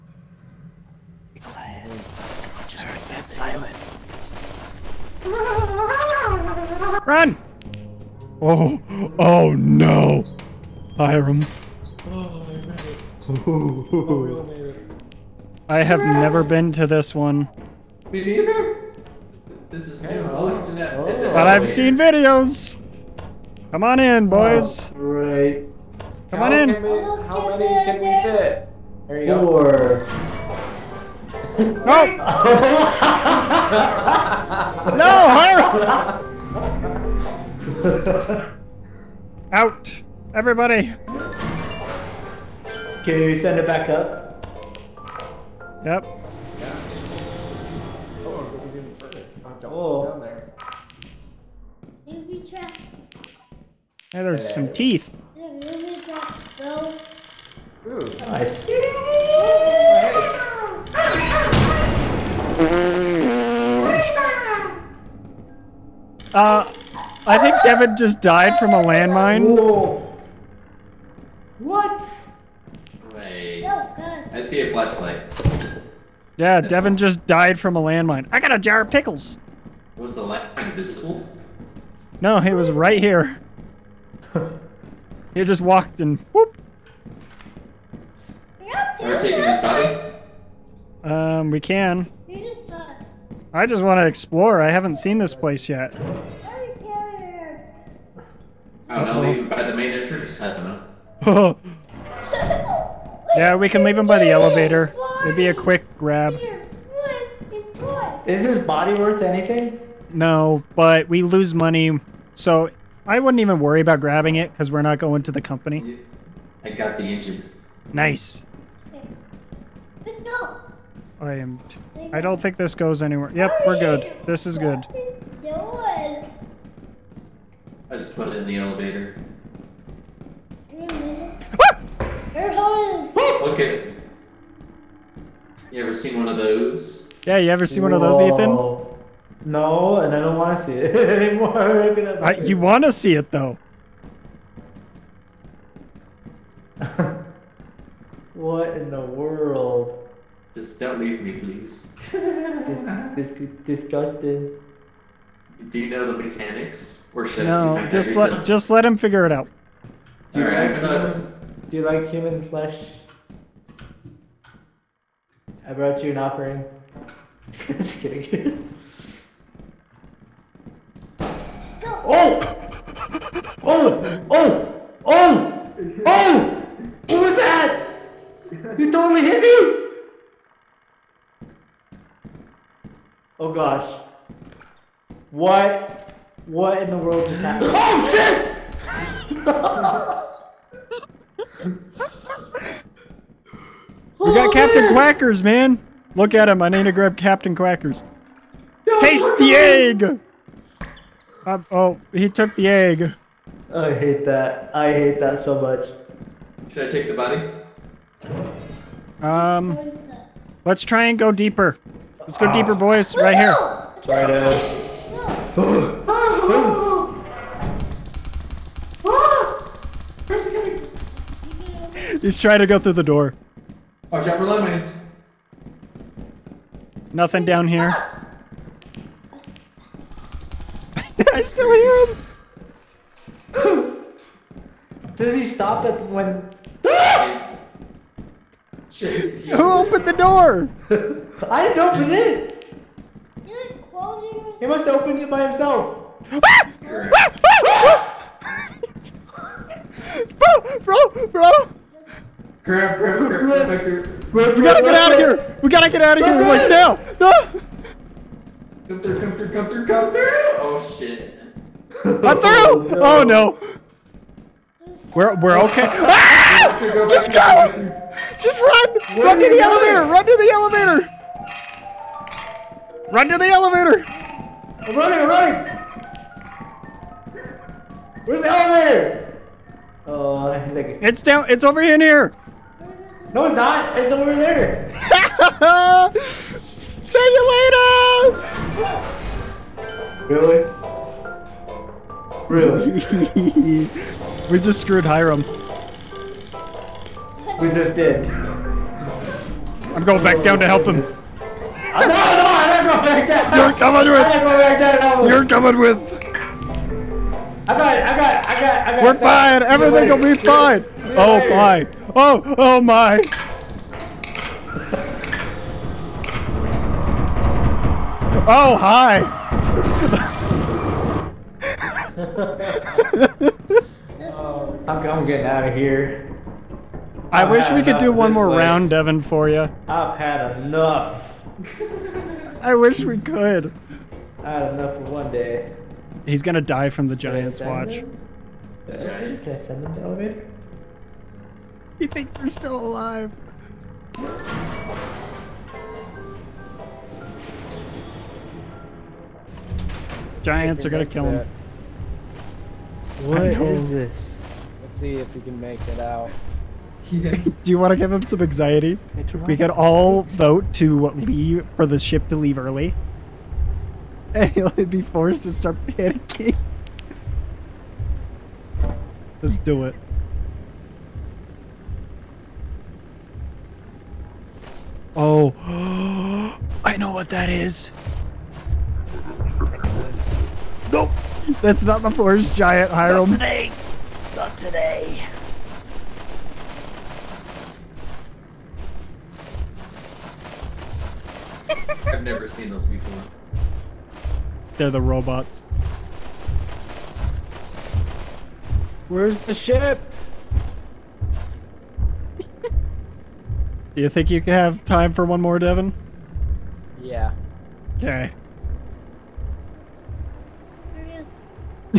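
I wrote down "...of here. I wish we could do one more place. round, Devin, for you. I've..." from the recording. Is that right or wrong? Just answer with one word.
right.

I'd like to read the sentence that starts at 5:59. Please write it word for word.
We could all vote to leave for the ship to leave early.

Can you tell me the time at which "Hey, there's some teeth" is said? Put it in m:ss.
0:54.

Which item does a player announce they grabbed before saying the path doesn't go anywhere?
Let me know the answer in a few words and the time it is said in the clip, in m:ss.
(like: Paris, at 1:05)
The engine, at 1:56.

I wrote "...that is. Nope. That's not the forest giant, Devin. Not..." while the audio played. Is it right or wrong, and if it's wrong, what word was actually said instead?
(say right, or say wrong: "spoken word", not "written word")
wrong: "Hiram", not "Devin".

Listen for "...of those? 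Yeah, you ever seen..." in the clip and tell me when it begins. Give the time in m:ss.
2:16.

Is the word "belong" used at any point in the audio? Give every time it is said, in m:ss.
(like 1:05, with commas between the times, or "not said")
not said.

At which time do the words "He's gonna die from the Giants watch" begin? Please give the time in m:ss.
5:36.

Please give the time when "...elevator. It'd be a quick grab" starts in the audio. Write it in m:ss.
1:44.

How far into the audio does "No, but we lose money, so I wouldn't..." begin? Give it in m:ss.
1:50.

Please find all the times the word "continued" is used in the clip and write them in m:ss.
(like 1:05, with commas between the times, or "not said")
not said.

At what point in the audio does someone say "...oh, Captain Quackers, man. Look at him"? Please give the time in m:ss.
3:14.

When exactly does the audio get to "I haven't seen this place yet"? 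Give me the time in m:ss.
1:34.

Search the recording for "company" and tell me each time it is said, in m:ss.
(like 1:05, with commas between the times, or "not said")
1:55.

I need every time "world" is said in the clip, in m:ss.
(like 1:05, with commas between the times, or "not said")
2:29, 3:06.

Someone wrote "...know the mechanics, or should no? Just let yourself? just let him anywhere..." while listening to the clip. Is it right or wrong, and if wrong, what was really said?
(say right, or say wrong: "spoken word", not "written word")
wrong: "figure", not "anywhere".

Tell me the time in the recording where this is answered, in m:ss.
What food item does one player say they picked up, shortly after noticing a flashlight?
1:18.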